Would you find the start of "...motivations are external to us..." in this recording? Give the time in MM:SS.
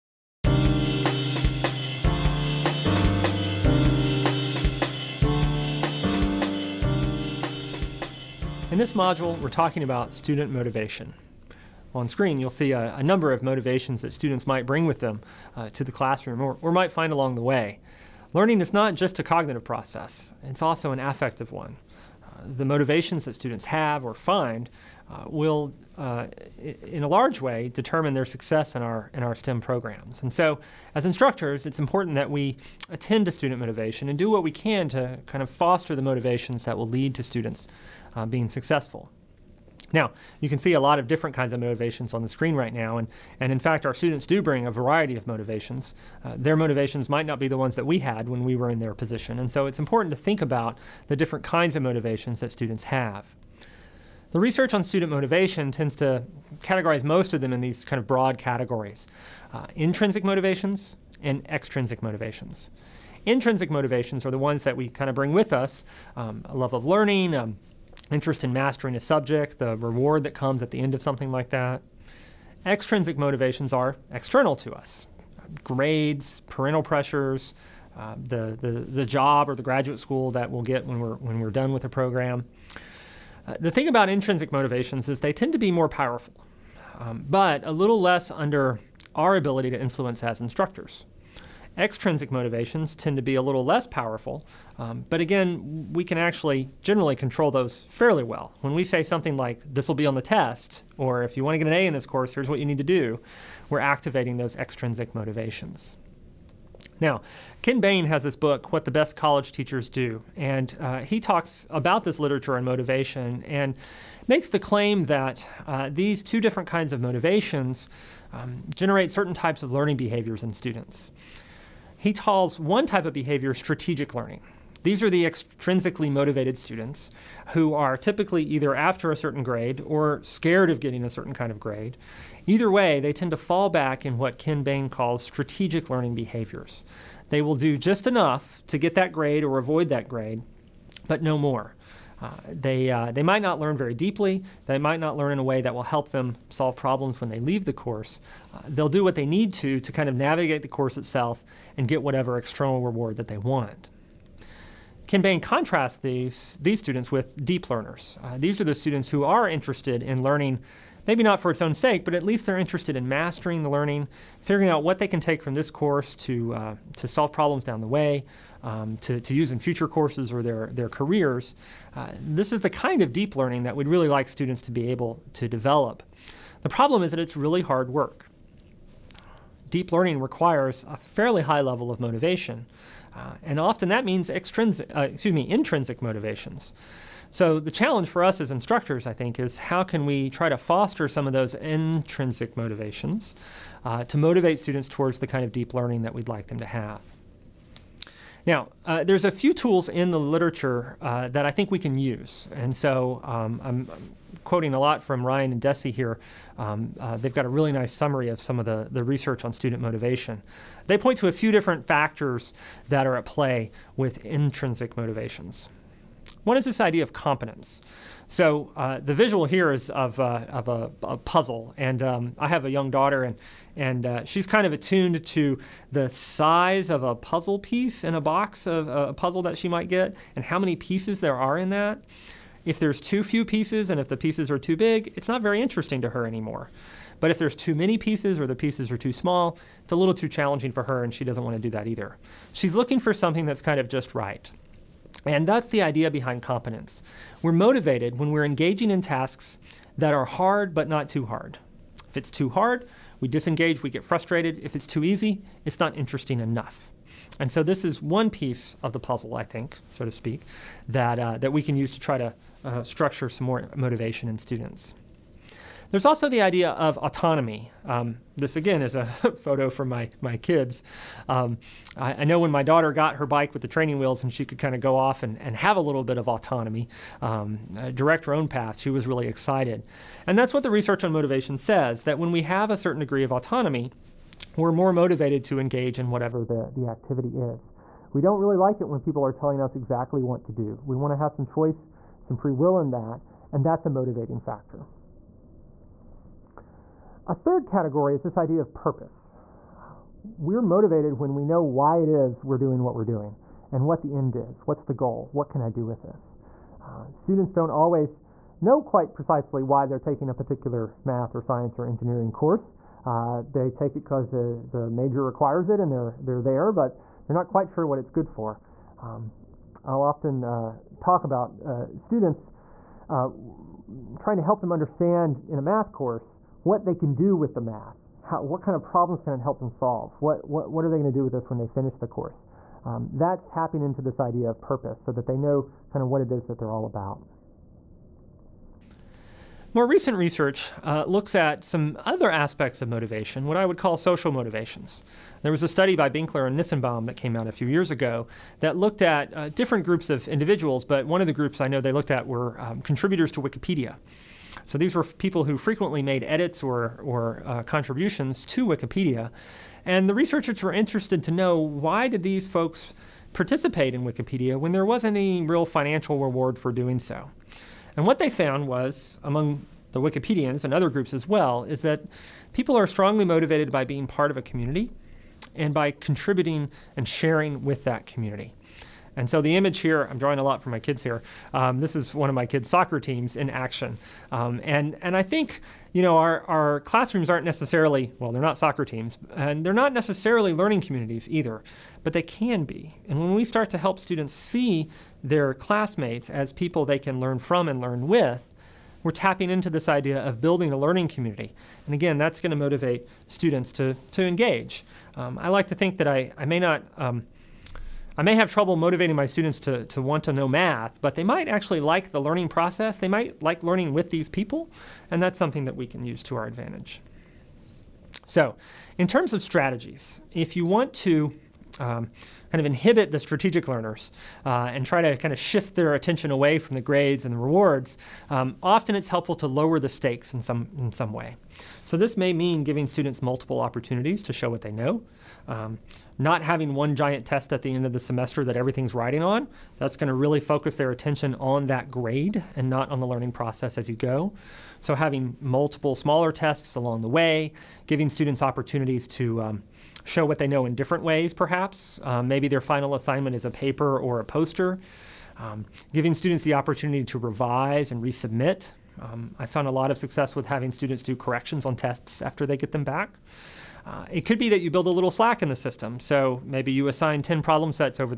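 01:13.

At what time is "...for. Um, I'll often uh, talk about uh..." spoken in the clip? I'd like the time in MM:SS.
05:18.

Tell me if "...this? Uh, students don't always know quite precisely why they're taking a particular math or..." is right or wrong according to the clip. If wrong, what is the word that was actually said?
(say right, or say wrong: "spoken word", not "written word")
right.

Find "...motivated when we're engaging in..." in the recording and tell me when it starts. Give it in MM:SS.
04:07.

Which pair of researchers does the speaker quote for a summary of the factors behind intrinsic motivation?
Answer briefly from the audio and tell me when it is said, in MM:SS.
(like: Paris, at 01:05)
Ryan and Deci, at 03:25.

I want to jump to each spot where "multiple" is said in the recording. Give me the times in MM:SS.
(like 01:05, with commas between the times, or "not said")
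07:13, 07:25.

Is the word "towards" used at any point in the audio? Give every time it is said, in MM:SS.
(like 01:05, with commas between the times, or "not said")
03:14.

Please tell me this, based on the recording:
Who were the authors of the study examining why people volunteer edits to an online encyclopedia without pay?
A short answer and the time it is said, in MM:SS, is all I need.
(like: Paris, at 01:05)
Benkler and Nissenbaum, at 05:46.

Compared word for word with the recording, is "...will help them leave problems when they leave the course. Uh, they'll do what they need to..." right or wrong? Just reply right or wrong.
wrong.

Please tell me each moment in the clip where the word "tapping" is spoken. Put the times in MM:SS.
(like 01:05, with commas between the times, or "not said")
05:33, 06:39.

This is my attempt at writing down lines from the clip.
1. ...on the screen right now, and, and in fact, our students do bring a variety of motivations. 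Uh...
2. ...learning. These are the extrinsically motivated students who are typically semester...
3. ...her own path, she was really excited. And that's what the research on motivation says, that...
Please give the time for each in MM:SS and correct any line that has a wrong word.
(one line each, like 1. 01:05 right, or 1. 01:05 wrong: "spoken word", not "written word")
1. 00:42 right
2. 02:04 wrong: "either", not "semester"
3. 04:38 right.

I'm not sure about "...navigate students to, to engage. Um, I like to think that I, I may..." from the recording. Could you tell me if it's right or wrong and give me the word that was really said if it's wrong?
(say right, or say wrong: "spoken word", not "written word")
wrong: "motivate", not "navigate".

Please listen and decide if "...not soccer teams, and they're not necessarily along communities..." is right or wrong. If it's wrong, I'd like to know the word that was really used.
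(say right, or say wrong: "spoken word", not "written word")
wrong: "learning", not "along".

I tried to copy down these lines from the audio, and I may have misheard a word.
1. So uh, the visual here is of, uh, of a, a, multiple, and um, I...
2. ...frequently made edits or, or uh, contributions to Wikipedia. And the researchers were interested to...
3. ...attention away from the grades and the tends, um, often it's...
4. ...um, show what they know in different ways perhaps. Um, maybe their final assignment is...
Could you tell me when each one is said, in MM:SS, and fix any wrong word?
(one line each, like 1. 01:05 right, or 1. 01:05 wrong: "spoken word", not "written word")
1. 03:38 wrong: "puzzle", not "multiple"
2. 05:55 right
3. 07:05 wrong: "rewards", not "tends"
4. 07:29 right.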